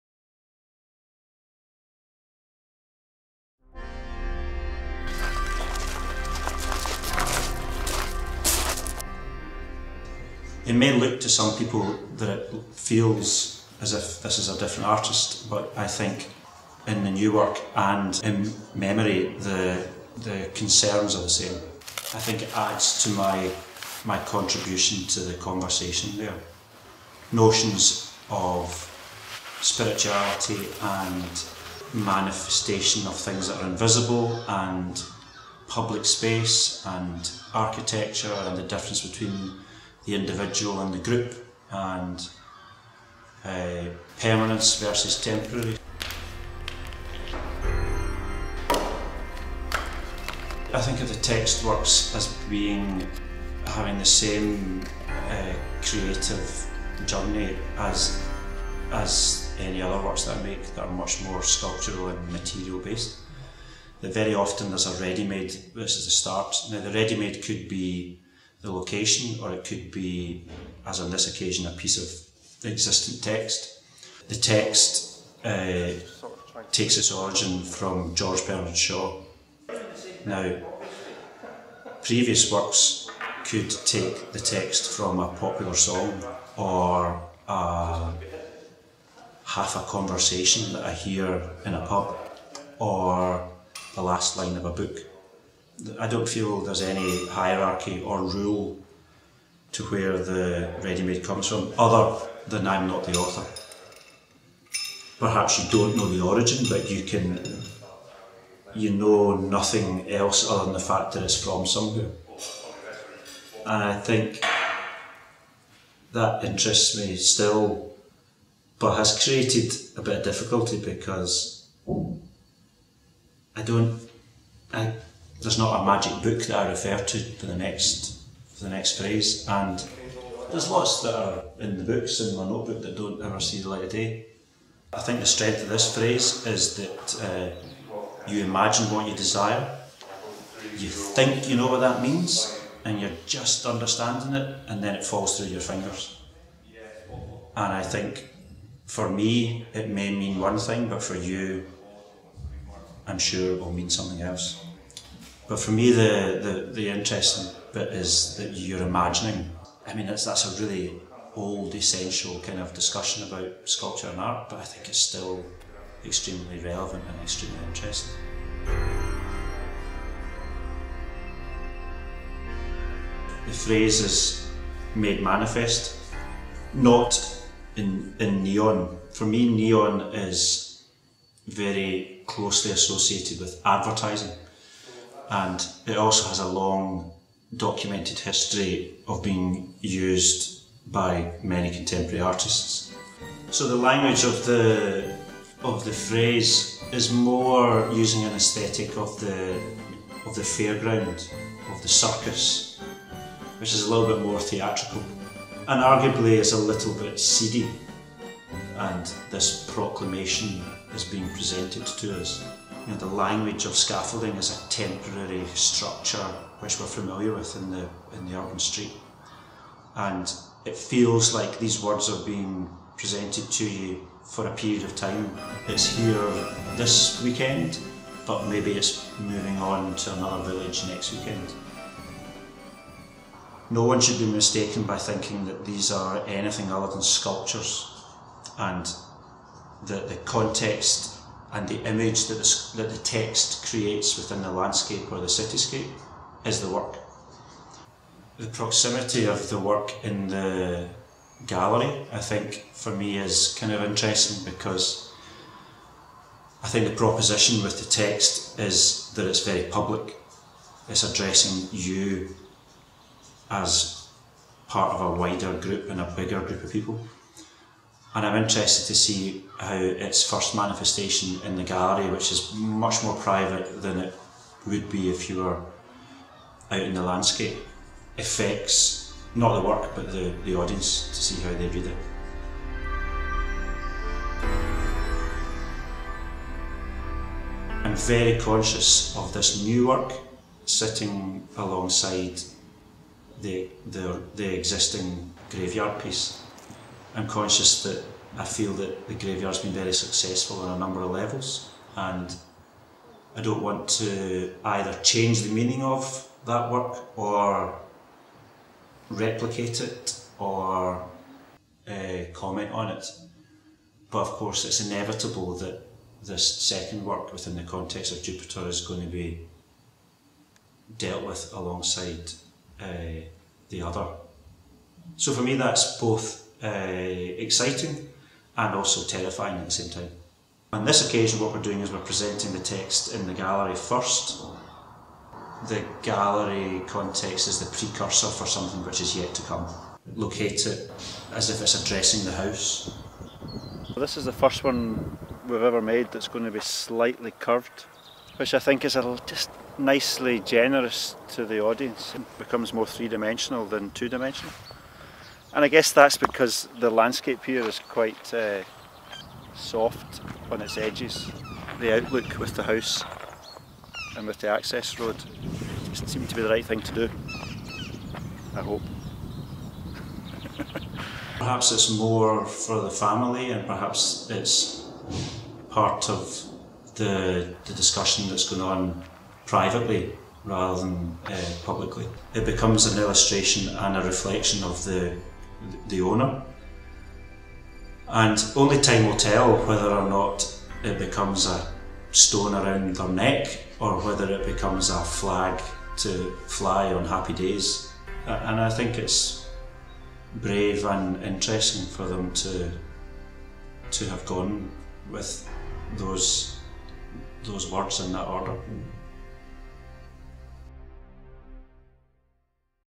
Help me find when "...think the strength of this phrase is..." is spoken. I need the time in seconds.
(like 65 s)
135 s.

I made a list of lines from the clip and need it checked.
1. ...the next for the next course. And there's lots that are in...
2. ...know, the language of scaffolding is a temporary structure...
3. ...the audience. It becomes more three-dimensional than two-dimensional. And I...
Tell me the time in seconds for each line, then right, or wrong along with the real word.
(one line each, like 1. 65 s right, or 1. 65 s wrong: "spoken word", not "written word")
1. 127 s wrong: "phrase", not "course"
2. 212 s right
3. 351 s right.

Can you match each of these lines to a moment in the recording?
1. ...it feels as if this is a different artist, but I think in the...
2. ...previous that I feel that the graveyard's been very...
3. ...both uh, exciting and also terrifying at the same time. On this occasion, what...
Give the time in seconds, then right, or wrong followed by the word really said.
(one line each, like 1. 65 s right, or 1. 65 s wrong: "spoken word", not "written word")
1. 12 s right
2. 297 s wrong: "conscious", not "previous"
3. 325 s right.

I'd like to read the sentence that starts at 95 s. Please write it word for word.
I don't feel there's any hierarchy or rule to where the ready-made comes from, other than I'm not the author.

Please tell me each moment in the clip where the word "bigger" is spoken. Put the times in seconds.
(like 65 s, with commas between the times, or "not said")
266 s.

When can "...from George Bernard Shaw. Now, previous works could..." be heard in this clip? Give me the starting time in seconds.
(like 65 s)
77 s.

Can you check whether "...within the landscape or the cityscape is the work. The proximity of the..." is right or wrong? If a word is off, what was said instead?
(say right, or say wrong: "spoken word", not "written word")
right.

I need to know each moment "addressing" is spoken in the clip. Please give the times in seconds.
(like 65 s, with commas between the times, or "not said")
261 s, 341 s.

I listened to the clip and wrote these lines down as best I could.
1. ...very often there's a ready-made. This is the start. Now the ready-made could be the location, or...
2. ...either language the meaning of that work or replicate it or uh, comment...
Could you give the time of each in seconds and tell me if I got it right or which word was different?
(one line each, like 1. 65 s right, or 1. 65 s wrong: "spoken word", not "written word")
1. 64 s right
2. 304 s wrong: "change", not "language".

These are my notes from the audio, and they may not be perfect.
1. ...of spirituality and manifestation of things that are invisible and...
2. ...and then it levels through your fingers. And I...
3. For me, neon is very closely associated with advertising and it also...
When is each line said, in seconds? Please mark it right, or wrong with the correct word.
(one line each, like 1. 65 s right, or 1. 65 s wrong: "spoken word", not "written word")
1. 28 s right
2. 144 s wrong: "falls", not "levels"
3. 179 s right.